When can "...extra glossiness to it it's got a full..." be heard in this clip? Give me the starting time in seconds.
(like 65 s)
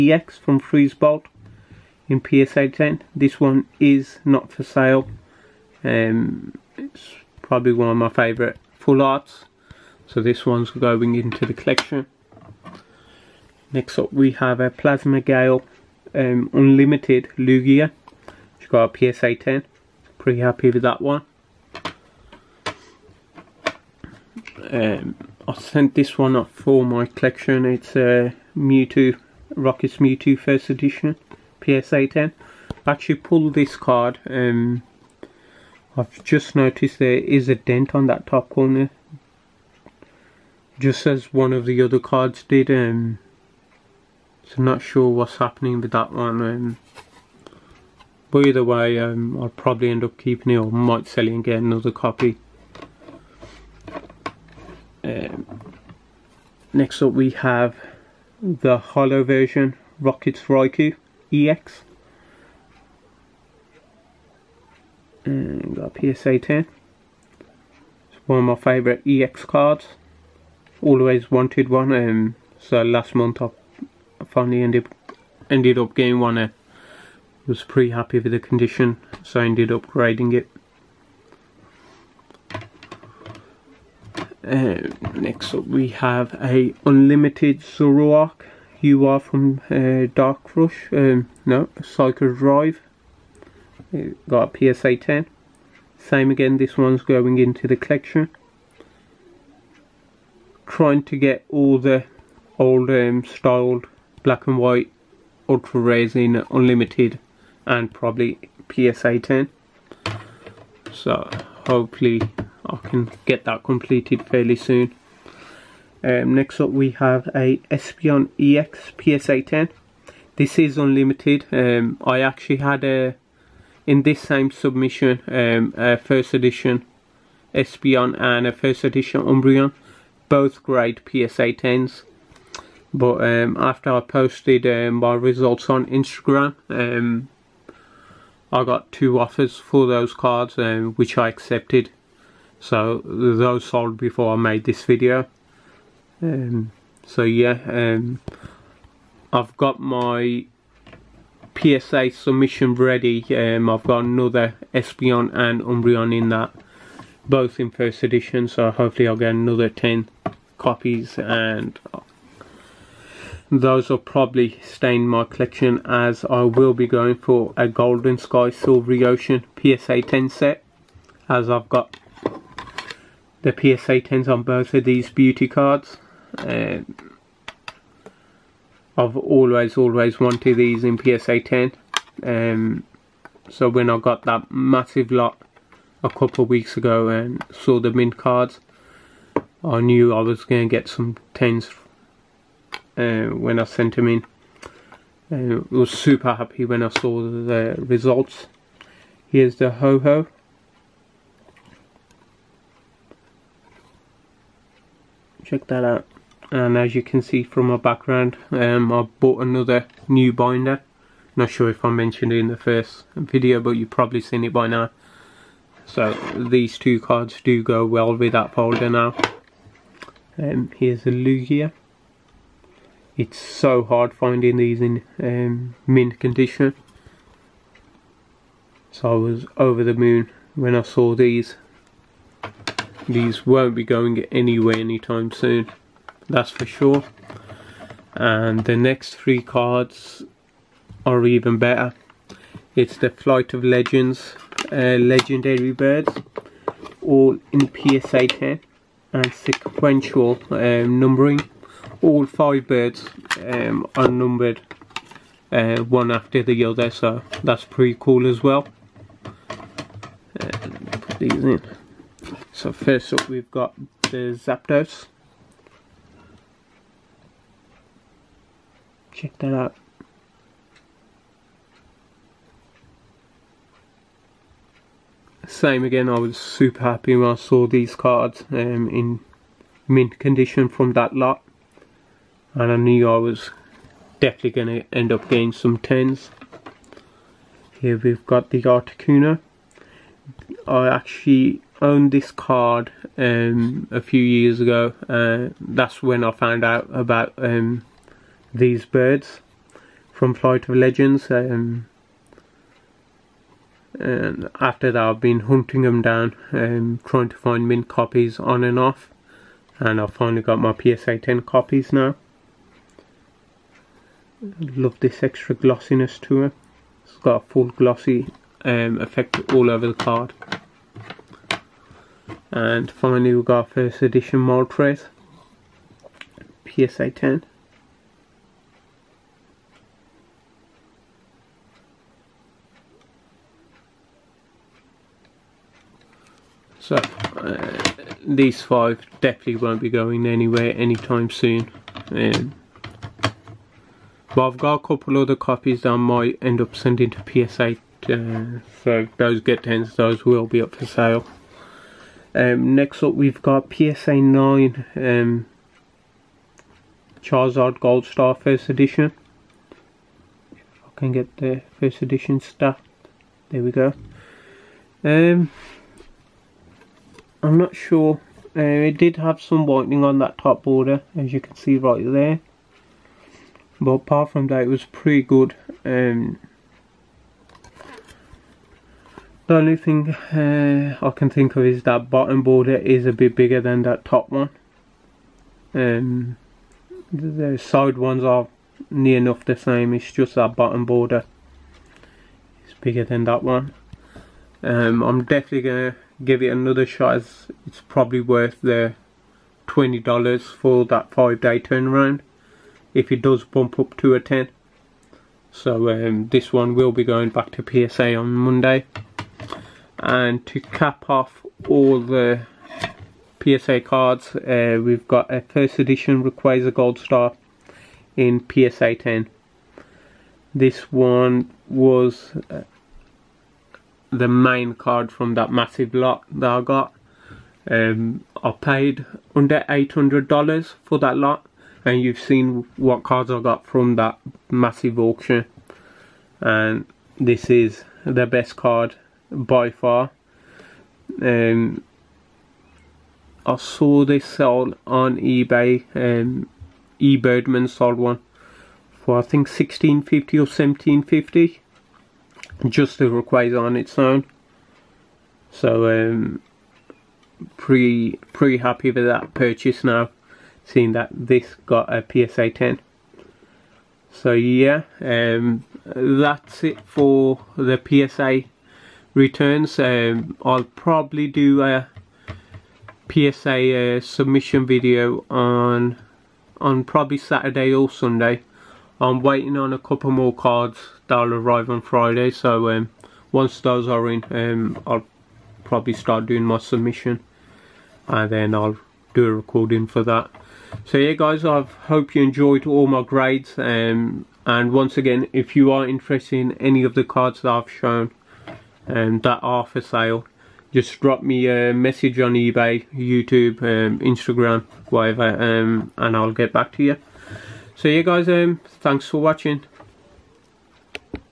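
315 s.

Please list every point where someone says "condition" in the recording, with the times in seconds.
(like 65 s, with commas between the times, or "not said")
78 s, 226 s, 280 s.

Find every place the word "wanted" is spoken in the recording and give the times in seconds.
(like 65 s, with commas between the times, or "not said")
71 s, 180 s.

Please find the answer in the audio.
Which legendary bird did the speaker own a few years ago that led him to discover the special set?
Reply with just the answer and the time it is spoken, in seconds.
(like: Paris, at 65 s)
Articuno, at 288 s.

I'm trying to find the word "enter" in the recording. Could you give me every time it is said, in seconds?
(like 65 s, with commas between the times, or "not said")
not said.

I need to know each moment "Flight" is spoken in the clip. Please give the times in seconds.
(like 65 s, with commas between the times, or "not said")
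243 s, 300 s.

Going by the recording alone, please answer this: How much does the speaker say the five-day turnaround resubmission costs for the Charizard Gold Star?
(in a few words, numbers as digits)
$20.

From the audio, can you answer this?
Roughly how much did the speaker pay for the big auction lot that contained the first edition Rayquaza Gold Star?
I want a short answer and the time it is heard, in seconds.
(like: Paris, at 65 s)
under $800, at 429 s.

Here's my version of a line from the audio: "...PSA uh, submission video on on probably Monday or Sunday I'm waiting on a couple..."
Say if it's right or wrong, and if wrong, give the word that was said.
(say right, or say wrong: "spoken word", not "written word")
wrong: "Saturday", not "Monday".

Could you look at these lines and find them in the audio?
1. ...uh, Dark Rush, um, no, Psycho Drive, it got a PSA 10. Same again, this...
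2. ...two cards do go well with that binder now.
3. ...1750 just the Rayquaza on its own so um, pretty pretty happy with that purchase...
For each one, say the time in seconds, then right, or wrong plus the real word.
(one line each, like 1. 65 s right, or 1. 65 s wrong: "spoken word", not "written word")
1. 89 s right
2. 216 s wrong: "folder", not "binder"
3. 450 s right.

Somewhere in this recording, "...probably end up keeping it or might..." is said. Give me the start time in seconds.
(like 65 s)
49 s.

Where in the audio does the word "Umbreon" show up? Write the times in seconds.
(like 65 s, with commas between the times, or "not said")
129 s, 155 s.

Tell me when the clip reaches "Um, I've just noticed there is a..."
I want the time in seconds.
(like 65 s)
34 s.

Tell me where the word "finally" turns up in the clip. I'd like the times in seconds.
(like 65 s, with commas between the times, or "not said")
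74 s, 310 s, 322 s.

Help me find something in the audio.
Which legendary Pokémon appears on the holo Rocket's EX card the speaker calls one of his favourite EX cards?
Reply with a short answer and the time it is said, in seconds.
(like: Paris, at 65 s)
Raikou, at 60 s.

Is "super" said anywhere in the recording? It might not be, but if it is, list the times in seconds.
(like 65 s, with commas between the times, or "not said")
195 s, 276 s.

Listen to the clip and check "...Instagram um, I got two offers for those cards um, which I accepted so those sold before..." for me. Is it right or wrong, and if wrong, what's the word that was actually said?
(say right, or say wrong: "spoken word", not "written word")
right.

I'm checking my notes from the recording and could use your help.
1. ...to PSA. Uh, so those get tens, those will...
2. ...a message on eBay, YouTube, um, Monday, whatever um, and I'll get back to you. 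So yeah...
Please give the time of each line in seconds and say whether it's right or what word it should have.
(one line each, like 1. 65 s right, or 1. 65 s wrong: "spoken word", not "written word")
1. 347 s right
2. 501 s wrong: "Instagram", not "Monday".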